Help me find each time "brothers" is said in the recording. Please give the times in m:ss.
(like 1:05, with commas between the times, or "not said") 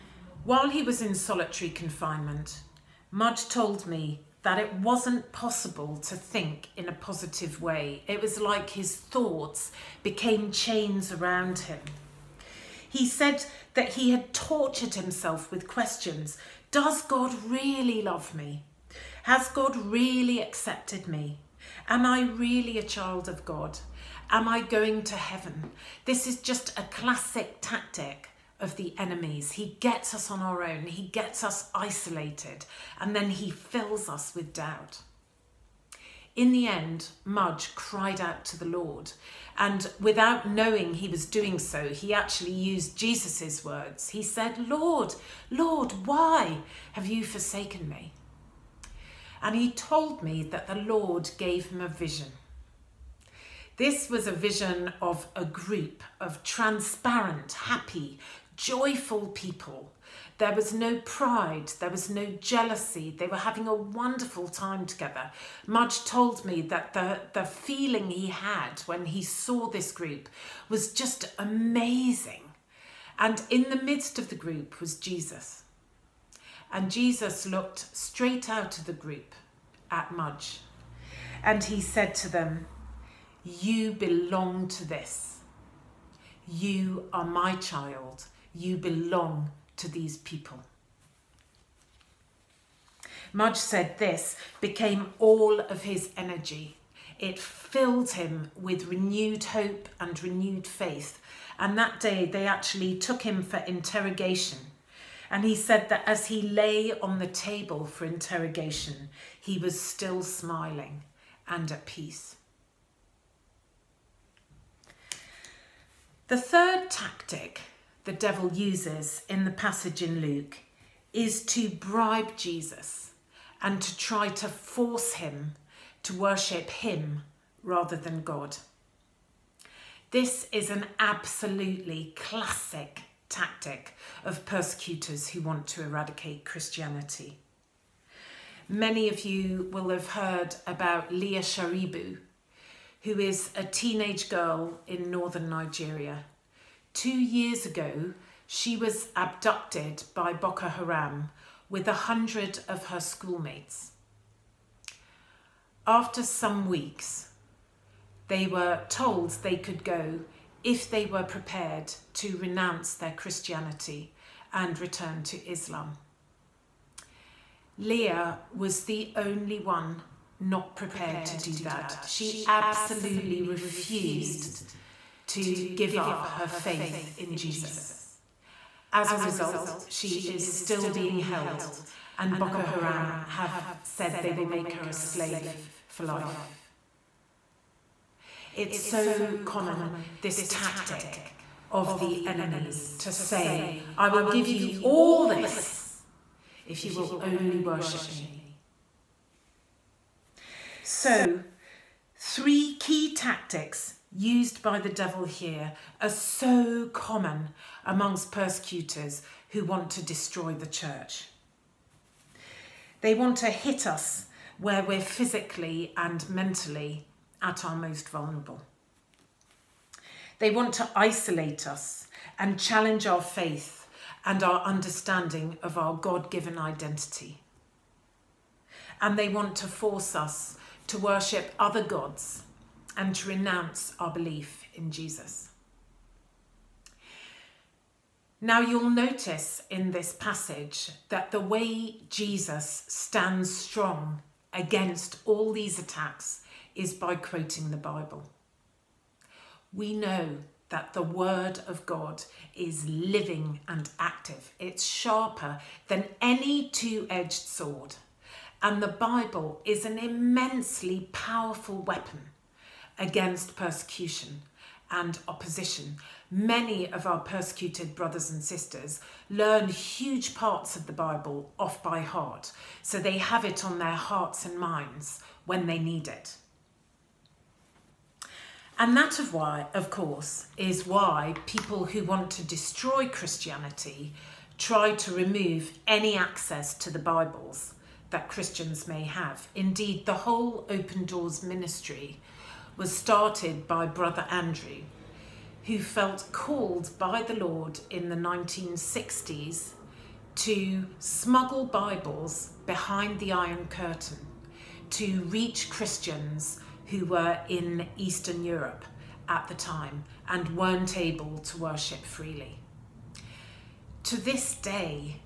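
4:27, 4:53.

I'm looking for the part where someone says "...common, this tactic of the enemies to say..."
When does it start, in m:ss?
3:09.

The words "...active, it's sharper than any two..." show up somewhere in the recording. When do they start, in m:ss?
4:13.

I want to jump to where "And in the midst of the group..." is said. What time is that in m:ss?
1:13.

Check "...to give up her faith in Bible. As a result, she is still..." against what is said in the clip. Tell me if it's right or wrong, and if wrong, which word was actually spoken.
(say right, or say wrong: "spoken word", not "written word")
wrong: "Jesus", not "Bible".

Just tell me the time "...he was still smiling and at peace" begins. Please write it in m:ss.
1:49.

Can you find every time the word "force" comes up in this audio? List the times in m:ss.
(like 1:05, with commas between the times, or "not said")
2:04, 3:49.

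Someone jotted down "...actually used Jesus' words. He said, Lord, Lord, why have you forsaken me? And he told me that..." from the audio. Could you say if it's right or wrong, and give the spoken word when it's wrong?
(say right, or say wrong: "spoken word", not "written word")
right.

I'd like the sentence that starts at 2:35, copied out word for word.
After some weeks, they were told they could go if they were prepared to renounce their Christianity and return to Islam.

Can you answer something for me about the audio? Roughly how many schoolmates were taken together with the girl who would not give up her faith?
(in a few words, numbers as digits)
100.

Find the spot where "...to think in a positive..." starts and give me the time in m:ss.
0:05.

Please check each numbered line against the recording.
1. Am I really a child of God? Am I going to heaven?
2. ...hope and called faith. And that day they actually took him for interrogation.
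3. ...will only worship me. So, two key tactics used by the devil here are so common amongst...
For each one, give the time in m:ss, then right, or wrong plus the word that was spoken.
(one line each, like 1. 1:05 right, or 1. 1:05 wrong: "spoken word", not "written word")
1. 0:21 right
2. 1:39 wrong: "renewed", not "called"
3. 3:16 wrong: "three", not "two".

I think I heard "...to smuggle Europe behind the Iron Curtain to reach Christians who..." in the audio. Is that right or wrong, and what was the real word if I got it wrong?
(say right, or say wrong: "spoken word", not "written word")
wrong: "Bibles", not "Europe".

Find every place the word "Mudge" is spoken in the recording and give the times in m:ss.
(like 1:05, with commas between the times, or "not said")
0:03, 0:37, 1:05, 1:20, 1:33.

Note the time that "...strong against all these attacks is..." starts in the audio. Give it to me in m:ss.
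4:03.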